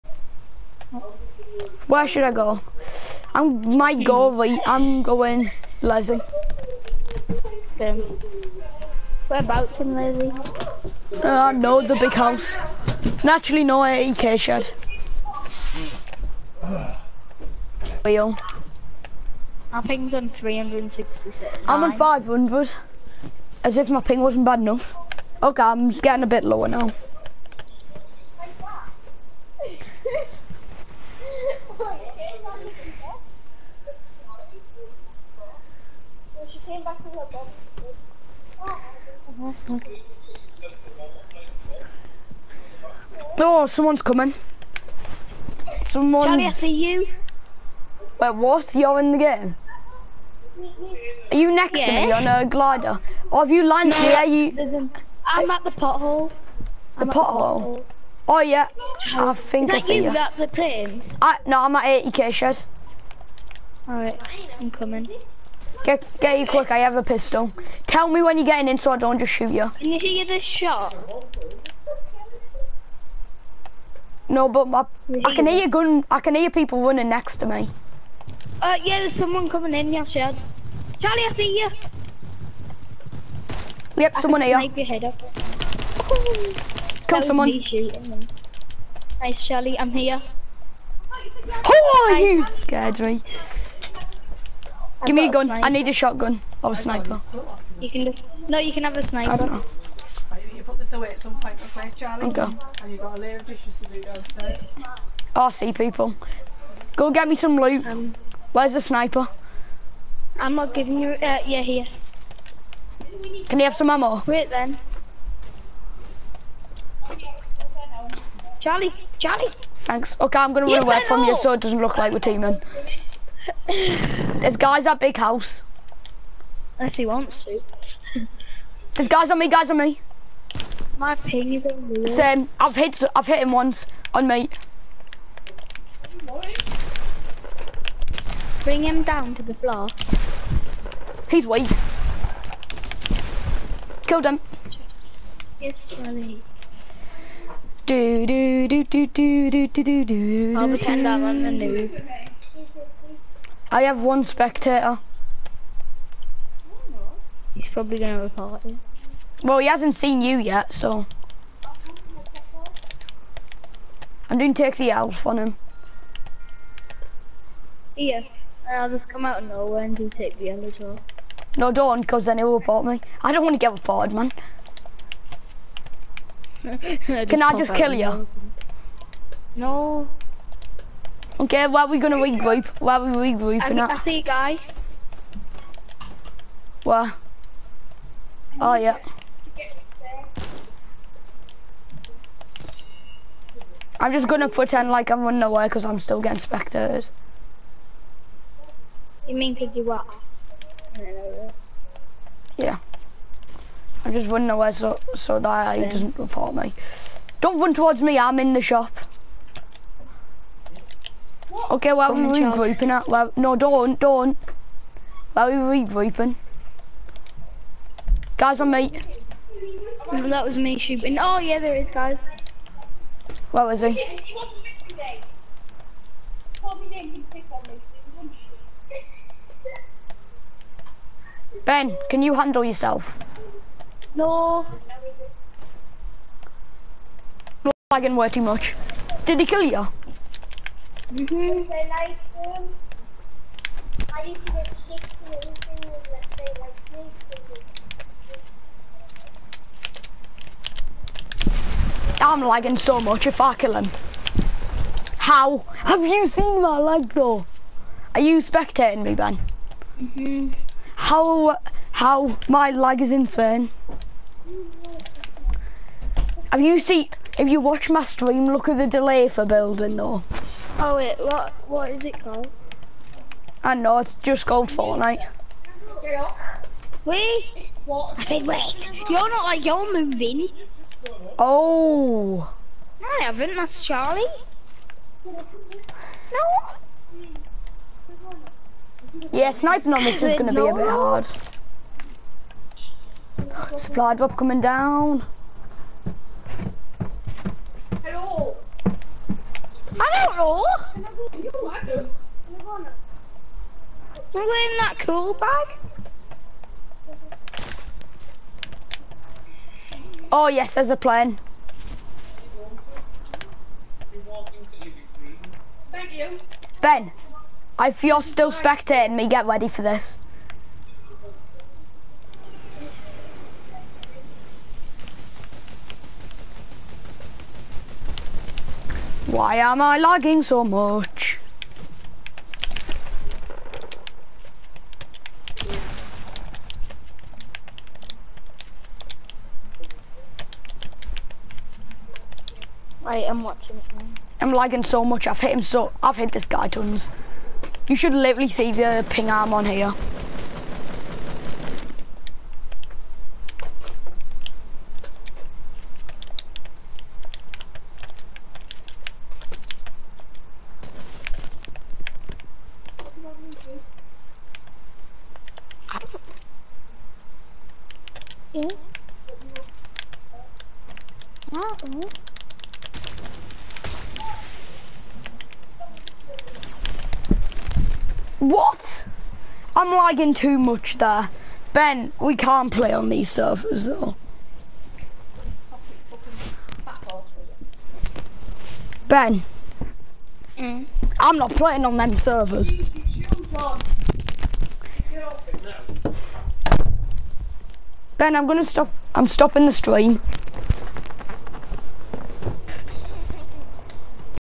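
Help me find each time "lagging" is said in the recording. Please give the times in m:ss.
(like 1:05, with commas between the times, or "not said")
3:57, 4:12, 5:29, 5:44, 6:19.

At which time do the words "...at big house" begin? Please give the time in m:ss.
2:04.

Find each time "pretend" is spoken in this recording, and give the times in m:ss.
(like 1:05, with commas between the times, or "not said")
2:30, 3:14.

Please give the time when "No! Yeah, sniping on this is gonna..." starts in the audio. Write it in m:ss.
4:45.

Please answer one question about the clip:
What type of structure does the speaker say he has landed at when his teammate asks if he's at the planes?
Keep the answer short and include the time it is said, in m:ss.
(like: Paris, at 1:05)
80k shed, at 1:02.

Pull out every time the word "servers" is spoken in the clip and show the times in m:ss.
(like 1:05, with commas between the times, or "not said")
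6:23, 6:32.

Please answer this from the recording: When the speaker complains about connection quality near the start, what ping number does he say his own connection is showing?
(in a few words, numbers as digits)
500.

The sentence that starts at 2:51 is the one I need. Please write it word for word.
No, don't, because then he'll report me.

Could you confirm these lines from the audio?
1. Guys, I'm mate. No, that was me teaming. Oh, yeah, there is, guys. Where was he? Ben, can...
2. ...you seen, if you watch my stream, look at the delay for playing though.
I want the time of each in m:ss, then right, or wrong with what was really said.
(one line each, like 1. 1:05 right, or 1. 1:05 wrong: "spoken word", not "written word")
1. 3:38 wrong: "shooting", not "teaming"
2. 4:26 wrong: "building", not "playing".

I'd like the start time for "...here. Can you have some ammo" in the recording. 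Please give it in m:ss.
1:51.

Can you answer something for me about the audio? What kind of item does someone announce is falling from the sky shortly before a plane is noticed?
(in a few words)
Supply drop.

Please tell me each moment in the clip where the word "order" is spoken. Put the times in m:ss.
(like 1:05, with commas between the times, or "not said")
not said.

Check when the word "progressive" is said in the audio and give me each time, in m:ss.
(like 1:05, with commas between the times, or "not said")
not said.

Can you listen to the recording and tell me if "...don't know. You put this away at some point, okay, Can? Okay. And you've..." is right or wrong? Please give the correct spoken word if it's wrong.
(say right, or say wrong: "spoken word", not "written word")
wrong: "Charlie", not "Can".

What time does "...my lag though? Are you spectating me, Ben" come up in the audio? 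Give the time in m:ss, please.
4:16.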